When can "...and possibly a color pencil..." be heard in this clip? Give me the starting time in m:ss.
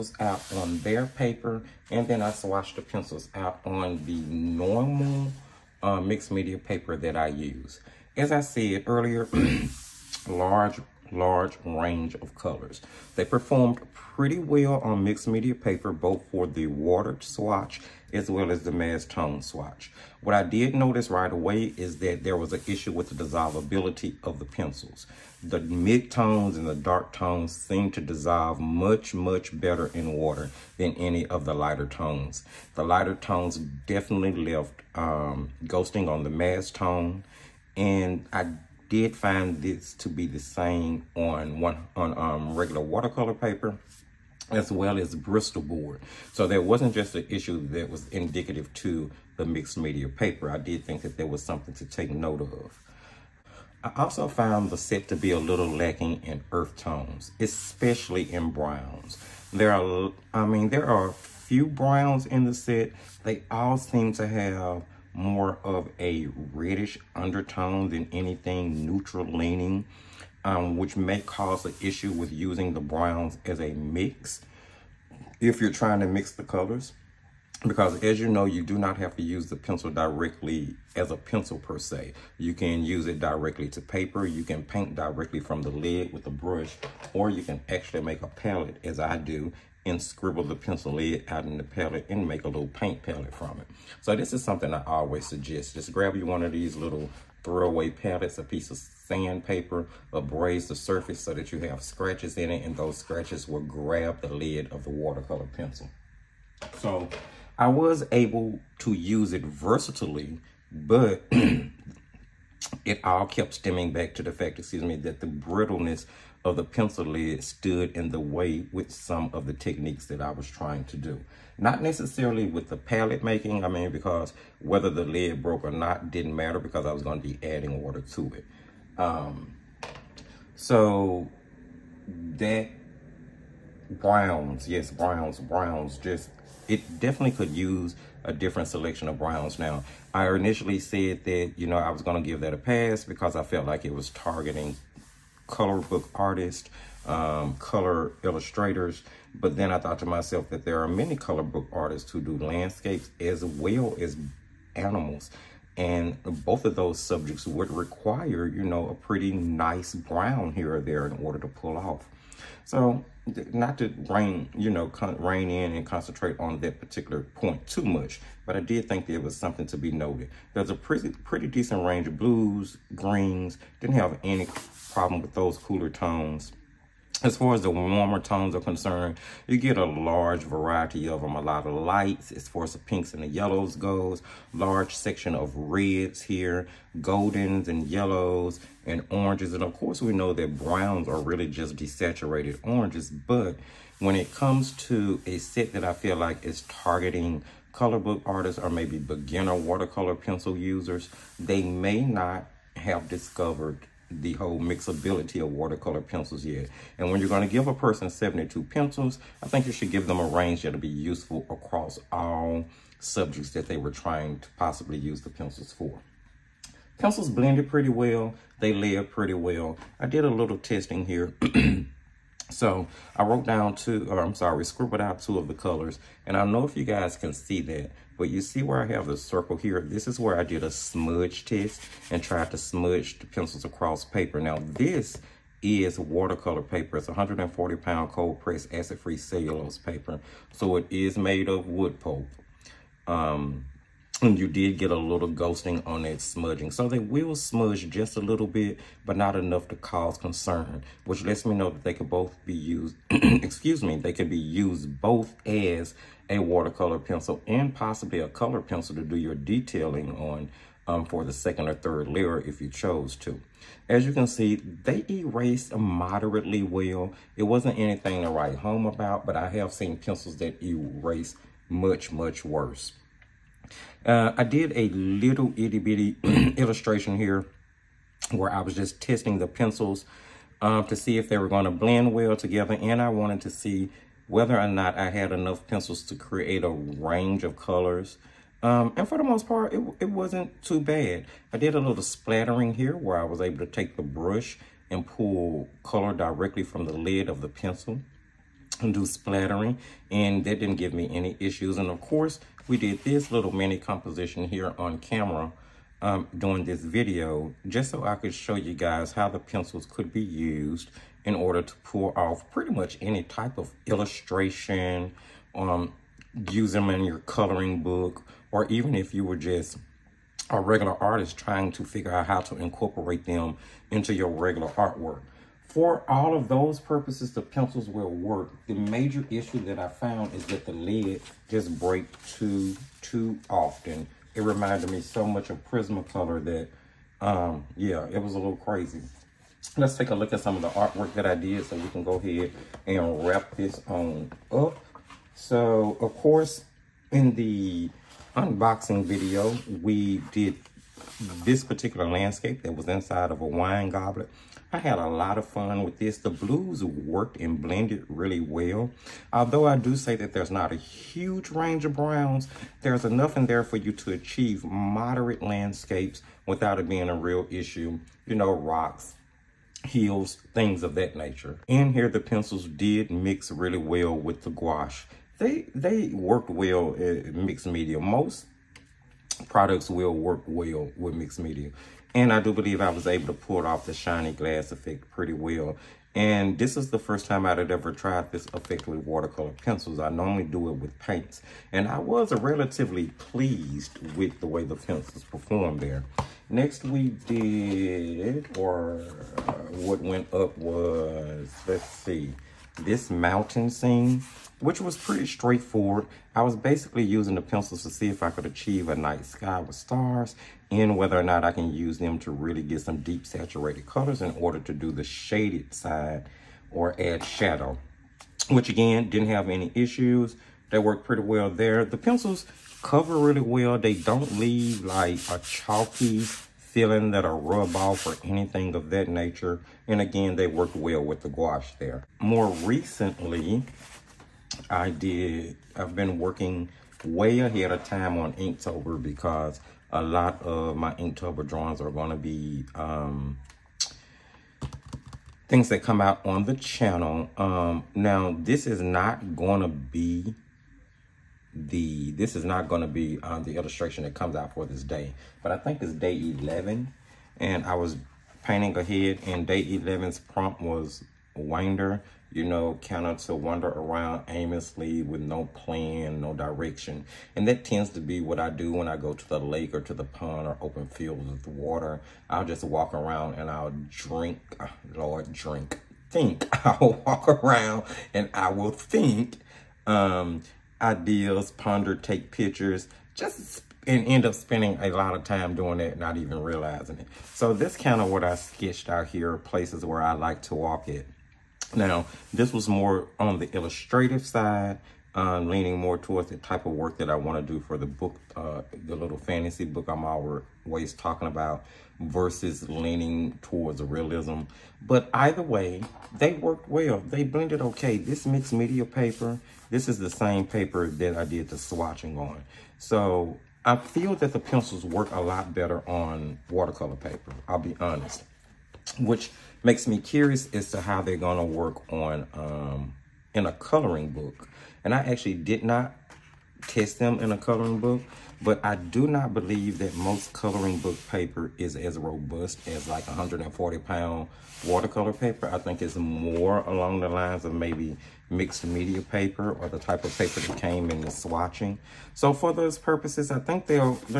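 4:17.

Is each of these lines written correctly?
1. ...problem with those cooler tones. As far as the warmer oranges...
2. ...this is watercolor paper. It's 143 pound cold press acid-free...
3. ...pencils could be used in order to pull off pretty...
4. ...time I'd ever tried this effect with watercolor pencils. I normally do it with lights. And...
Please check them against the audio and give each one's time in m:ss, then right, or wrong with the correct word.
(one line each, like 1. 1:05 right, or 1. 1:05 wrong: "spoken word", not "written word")
1. 2:54 wrong: "tones", not "oranges"
2. 3:54 wrong: "140", not "143"
3. 5:09 right
4. 6:27 wrong: "paints", not "lights".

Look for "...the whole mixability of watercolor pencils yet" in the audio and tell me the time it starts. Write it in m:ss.
3:24.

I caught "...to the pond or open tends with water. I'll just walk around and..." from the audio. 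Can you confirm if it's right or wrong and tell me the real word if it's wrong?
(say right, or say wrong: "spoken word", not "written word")
wrong: "fields", not "tends".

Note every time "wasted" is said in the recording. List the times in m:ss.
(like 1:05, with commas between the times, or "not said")
not said.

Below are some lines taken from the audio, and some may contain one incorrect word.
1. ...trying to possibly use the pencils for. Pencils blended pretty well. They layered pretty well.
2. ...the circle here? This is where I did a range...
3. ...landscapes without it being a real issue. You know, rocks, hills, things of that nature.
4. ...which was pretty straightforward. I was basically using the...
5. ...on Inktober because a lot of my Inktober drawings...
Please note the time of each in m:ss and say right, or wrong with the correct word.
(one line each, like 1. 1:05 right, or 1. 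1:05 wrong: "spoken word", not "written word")
1. 3:33 right
2. 3:49 wrong: "smudge", not "range"
3. 6:05 right
4. 6:44 right
5. 7:18 right.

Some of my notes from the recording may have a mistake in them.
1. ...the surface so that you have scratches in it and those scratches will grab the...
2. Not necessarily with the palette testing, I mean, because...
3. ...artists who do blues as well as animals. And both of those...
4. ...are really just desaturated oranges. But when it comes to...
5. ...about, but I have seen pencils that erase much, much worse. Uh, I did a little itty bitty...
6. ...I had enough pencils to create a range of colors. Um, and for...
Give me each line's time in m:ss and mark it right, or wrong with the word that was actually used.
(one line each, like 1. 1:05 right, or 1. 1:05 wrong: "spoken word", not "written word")
1. 1:40 right
2. 2:01 wrong: "making", not "testing"
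3. 2:31 wrong: "landscapes", not "blues"
4. 3:11 right
5. 4:28 right
6. 4:44 right.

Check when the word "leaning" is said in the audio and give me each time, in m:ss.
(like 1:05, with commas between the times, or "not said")
1:09, 8:15, 8:22.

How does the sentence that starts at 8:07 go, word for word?
So this kind of what I sketched out here, places where I like to walk it.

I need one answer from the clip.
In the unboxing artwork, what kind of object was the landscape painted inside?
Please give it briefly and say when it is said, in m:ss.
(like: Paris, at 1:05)
a wine goblet, at 5:53.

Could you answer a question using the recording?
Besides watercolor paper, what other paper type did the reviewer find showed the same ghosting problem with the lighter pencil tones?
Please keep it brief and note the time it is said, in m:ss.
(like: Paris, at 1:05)
Bristol board, at 0:45.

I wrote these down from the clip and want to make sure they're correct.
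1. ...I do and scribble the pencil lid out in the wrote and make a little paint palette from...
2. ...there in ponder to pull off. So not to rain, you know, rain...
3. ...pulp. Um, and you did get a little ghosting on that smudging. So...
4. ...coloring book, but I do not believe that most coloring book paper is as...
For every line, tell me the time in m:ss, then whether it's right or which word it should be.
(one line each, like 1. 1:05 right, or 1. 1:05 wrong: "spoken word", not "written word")
1. 1:28 wrong: "palette", not "wrote"
2. 2:40 wrong: "order", not "ponder"
3. 4:01 right
4. 8:47 right.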